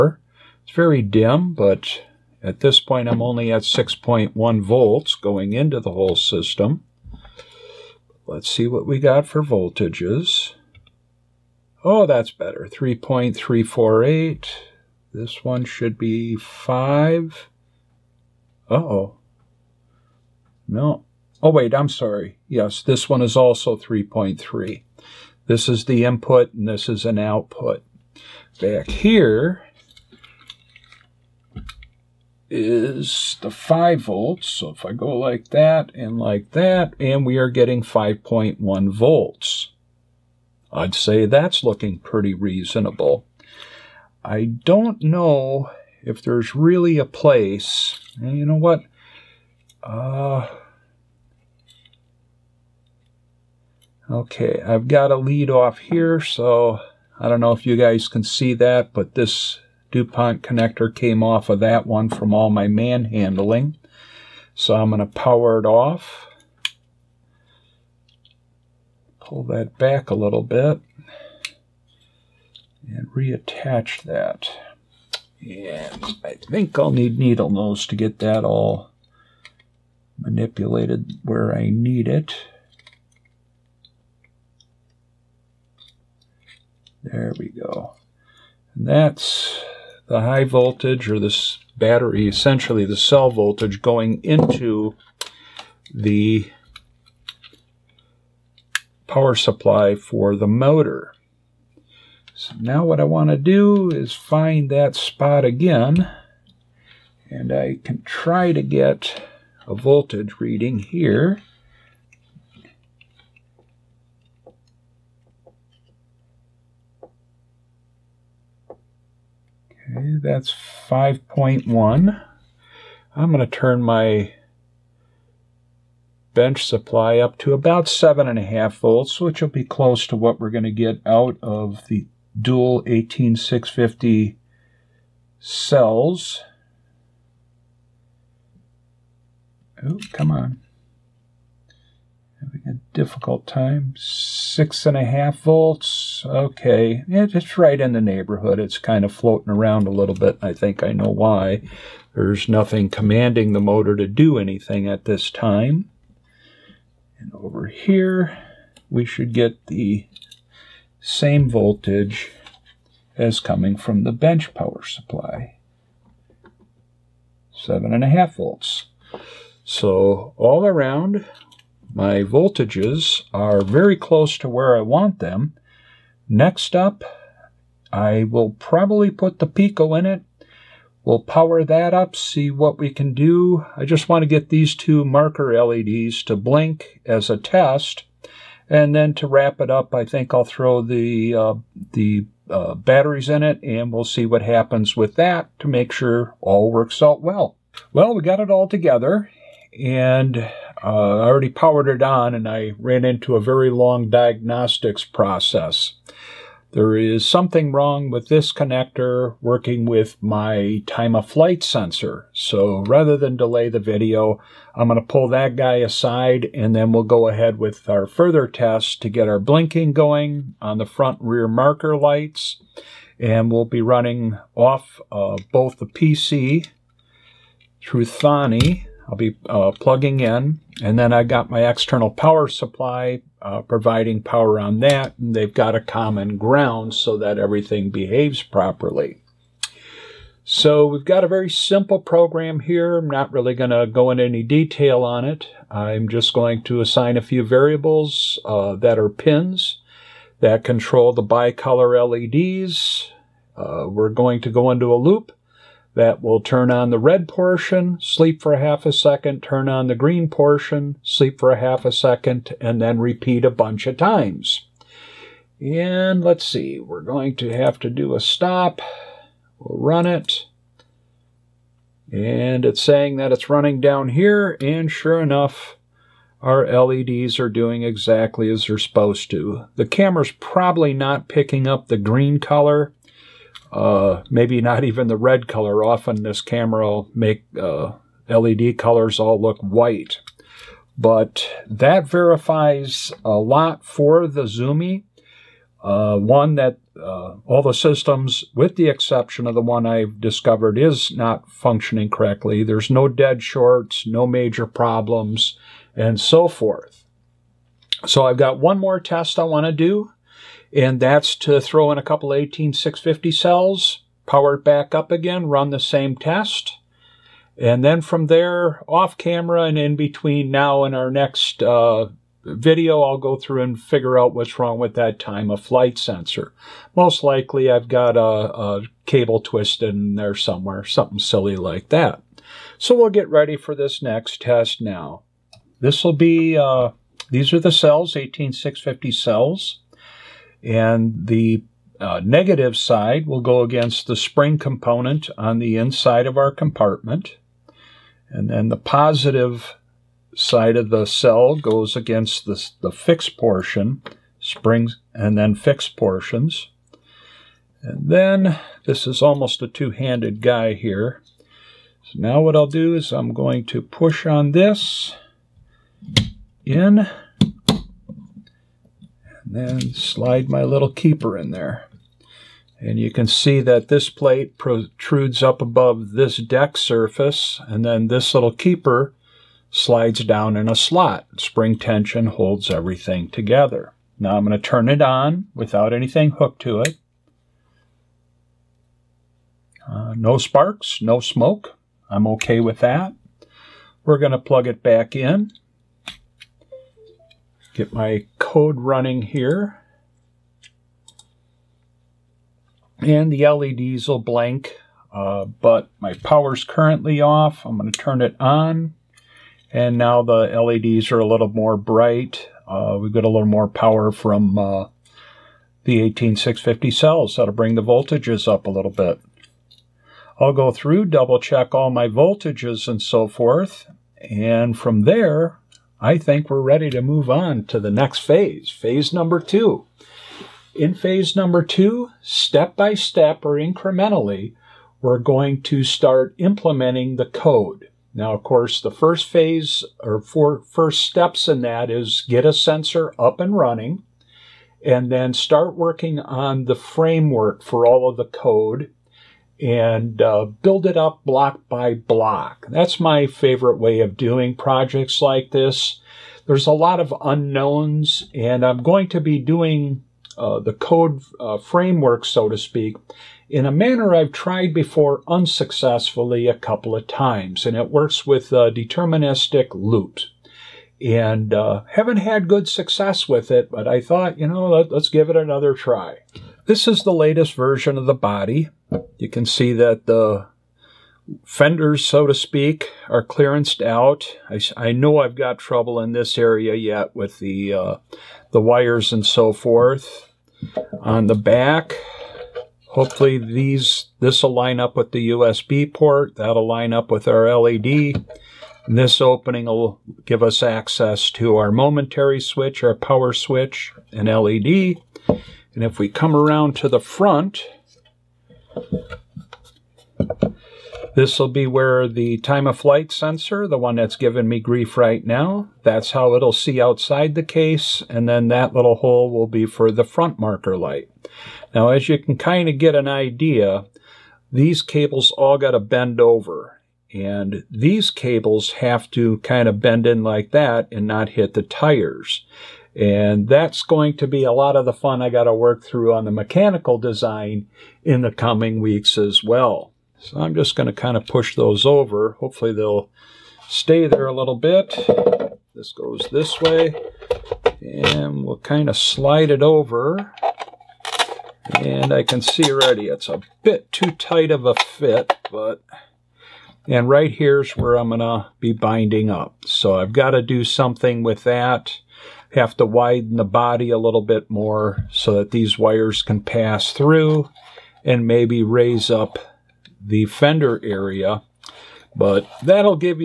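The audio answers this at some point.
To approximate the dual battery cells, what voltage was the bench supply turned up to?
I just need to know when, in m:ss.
2:07.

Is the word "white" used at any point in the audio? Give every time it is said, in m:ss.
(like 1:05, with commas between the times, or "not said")
4:49.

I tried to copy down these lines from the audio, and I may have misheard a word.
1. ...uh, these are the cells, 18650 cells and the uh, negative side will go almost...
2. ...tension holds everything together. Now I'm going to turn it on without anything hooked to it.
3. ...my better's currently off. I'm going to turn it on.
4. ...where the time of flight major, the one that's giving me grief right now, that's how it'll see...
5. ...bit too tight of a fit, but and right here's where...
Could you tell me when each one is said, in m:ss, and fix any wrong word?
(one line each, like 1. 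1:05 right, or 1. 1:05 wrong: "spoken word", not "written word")
1. 5:36 wrong: "against", not "almost"
2. 6:21 right
3. 6:45 wrong: "power", not "better"
4. 8:31 wrong: "sensor", not "major"
5. 9:13 right.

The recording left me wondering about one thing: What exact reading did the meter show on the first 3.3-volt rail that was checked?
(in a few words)
3.348.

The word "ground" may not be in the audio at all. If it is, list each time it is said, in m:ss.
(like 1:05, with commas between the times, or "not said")
3:56.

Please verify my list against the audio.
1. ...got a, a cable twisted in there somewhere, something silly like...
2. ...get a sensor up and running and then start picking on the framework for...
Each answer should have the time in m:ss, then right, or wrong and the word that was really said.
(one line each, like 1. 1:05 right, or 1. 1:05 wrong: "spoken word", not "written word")
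1. 5:27 right
2. 7:22 wrong: "working", not "picking".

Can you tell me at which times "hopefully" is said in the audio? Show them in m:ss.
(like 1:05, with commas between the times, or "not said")
8:12, 9:02.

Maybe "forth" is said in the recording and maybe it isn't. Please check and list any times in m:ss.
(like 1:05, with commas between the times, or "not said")
5:06, 7:03, 8:09.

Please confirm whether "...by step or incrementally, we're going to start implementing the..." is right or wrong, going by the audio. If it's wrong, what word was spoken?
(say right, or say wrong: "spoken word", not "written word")
right.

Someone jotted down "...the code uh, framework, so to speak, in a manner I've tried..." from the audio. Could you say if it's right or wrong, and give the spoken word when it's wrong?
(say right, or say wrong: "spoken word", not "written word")
right.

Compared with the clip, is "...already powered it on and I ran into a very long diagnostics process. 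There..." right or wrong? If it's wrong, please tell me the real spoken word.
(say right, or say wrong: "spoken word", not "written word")
right.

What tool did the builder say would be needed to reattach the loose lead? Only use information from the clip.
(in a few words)
Needle nose.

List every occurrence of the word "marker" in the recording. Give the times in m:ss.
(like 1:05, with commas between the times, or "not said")
3:05, 3:41, 8:40.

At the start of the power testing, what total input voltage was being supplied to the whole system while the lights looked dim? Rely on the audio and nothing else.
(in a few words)
6.1 volts.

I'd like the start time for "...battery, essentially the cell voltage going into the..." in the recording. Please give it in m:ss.
1:31.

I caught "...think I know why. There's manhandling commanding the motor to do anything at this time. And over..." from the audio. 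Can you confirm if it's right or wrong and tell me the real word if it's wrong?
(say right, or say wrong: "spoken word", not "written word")
wrong: "nothing", not "manhandling".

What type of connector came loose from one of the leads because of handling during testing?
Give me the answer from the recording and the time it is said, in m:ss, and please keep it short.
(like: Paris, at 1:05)
DuPont connector, at 0:59.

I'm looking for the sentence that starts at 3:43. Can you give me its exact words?
And we'll be running off both the PC through Thonny I'll be uh, plugging in.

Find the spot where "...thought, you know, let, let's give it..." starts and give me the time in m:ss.
7:54.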